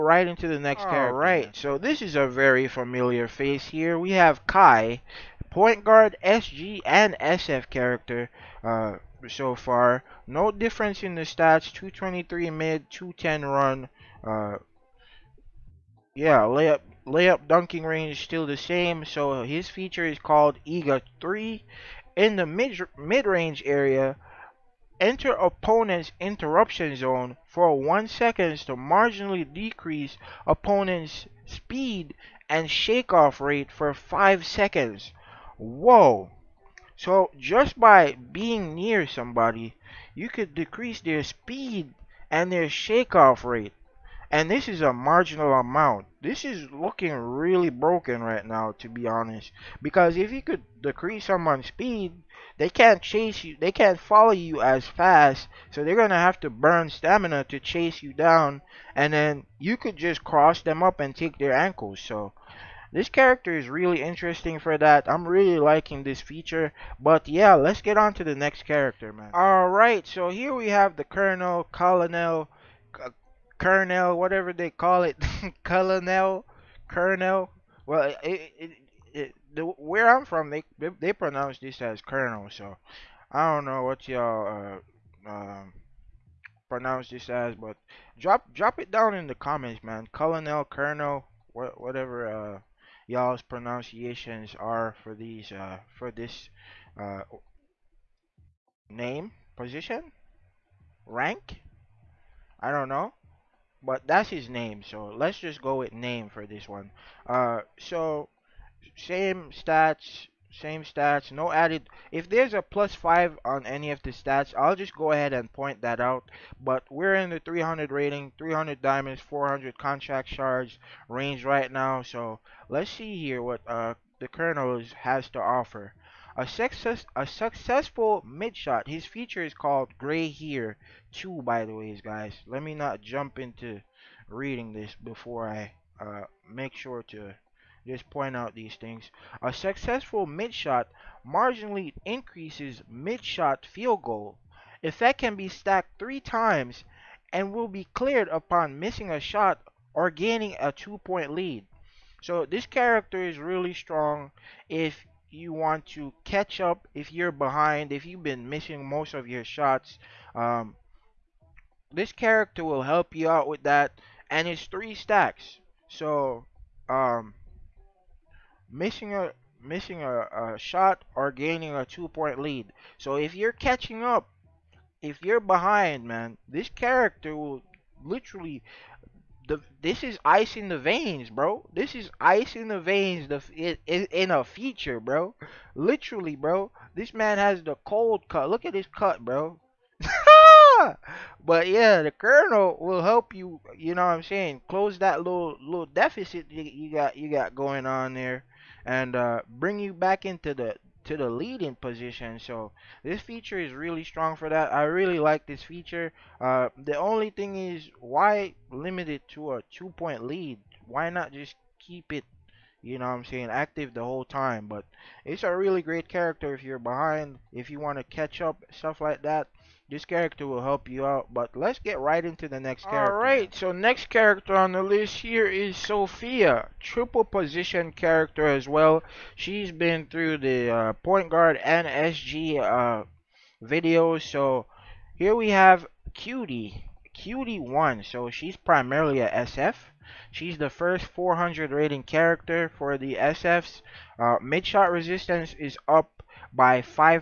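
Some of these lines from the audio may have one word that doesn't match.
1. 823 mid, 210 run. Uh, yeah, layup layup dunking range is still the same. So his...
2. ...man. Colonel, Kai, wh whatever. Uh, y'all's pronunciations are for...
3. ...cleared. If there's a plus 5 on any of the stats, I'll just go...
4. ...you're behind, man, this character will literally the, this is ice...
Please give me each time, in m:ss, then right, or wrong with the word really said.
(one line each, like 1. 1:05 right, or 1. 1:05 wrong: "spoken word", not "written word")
1. 0:11 wrong: "223", not "823"
2. 1:29 wrong: "Colonel", not "Kai"
3. 1:51 wrong: "added", not "cleared"
4. 2:55 right.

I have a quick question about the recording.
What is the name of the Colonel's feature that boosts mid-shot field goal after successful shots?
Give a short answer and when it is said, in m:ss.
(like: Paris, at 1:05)
Gray Here 2, at 2:09.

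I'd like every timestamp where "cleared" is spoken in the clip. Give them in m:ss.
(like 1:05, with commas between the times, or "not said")
2:27.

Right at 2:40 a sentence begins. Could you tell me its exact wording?
Um, this character will help you out with that.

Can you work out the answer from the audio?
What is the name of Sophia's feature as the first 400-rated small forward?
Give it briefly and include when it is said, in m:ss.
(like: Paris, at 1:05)
Cutie 1, at 3:57.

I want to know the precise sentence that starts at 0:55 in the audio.
So they're gonna have to burn stamina to chase you down.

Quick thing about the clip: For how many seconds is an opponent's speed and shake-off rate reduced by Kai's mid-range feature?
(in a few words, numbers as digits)
5 seconds.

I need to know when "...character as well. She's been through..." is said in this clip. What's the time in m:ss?
3:47.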